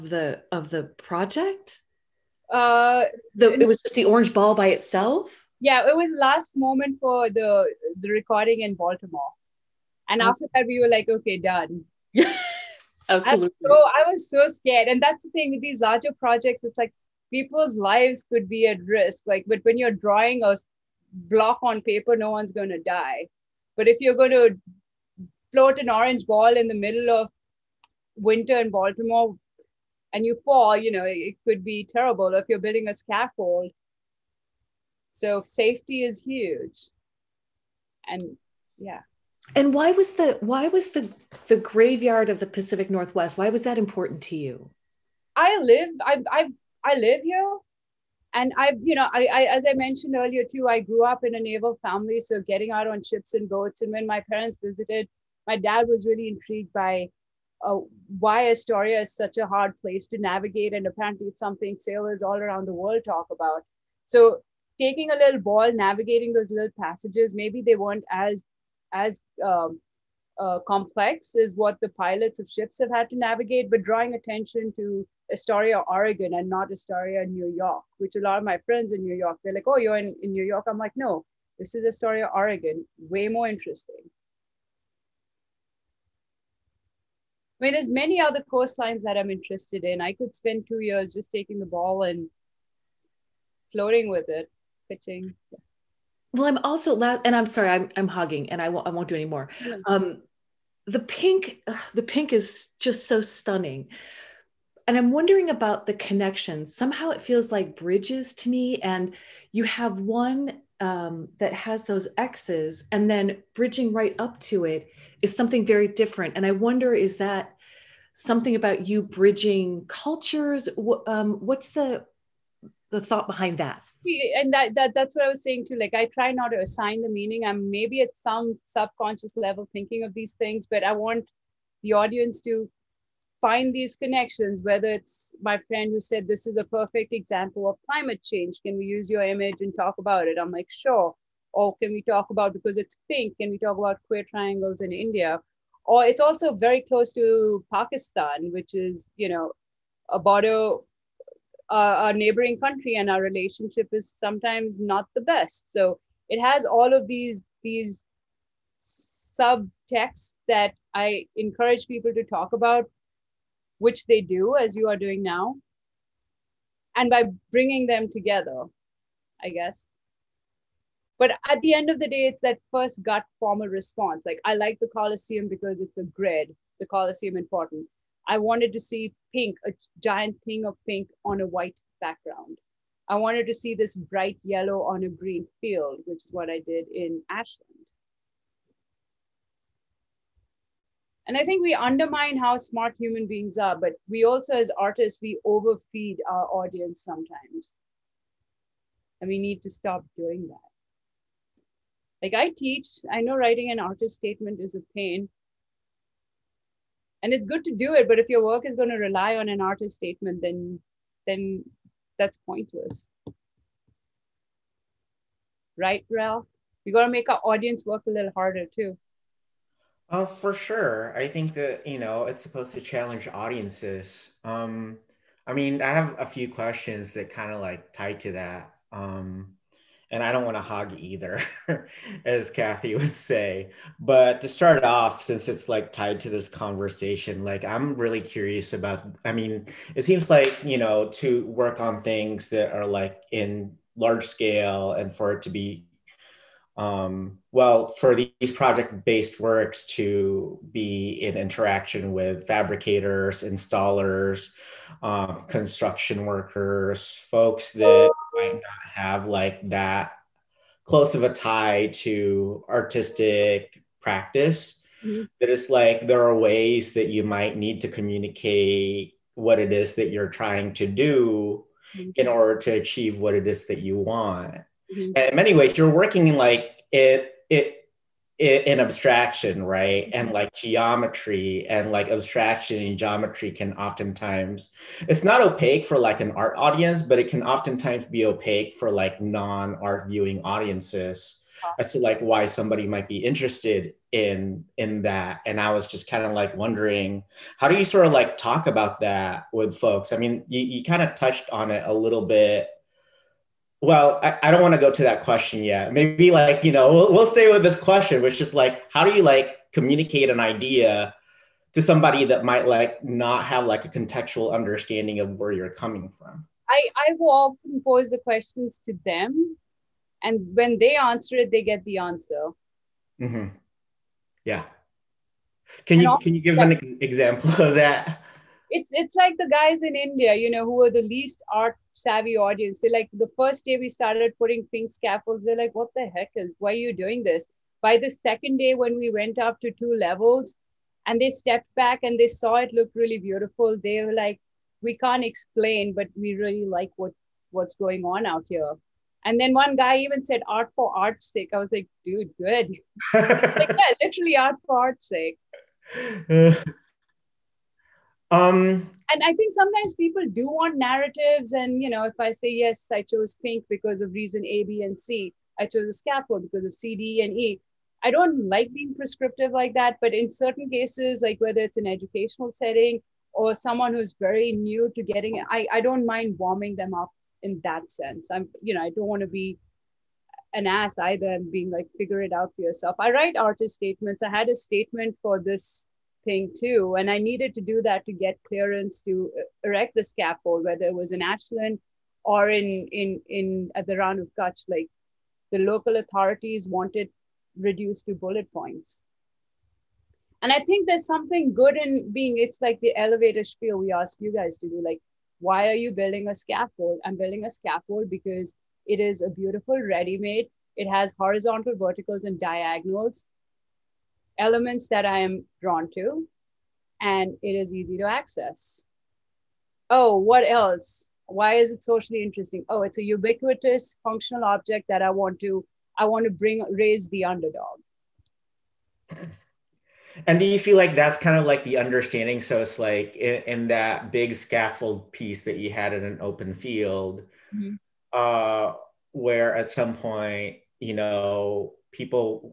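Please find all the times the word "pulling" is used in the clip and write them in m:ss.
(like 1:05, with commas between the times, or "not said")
not said.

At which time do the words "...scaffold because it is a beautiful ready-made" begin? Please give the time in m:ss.
6:47.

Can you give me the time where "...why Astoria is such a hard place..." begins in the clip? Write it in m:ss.
0:58.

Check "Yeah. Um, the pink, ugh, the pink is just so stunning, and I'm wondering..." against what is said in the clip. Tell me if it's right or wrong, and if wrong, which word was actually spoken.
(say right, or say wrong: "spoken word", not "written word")
right.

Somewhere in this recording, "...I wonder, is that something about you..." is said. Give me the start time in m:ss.
1:56.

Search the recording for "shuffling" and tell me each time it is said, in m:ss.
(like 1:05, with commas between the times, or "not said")
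not said.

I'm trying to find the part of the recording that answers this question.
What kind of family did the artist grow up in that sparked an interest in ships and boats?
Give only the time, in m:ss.
0:51.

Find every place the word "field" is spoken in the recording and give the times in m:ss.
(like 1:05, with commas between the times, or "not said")
3:05, 7:16.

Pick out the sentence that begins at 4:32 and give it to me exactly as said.
in order to achieve what it is that you want Mm-hmm.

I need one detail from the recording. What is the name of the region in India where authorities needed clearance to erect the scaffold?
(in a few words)
Rann of Kutch.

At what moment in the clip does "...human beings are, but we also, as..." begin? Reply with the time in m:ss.
3:12.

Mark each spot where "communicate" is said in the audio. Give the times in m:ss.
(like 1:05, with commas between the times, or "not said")
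4:27, 5:09.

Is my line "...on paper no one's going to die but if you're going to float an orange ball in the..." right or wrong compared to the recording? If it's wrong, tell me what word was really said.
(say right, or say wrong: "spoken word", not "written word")
right.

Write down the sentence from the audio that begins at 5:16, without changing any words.
I, I will often pose the questions to them.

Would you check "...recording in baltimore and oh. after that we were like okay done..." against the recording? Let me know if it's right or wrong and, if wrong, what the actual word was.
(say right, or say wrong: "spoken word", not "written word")
right.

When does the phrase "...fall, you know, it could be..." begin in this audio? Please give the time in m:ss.
0:30.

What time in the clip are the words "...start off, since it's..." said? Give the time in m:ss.
3:54.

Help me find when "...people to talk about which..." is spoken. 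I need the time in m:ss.
2:41.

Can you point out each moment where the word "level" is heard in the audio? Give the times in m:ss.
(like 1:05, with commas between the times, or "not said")
2:09, 5:39.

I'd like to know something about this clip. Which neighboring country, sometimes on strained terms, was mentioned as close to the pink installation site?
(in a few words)
Pakistan.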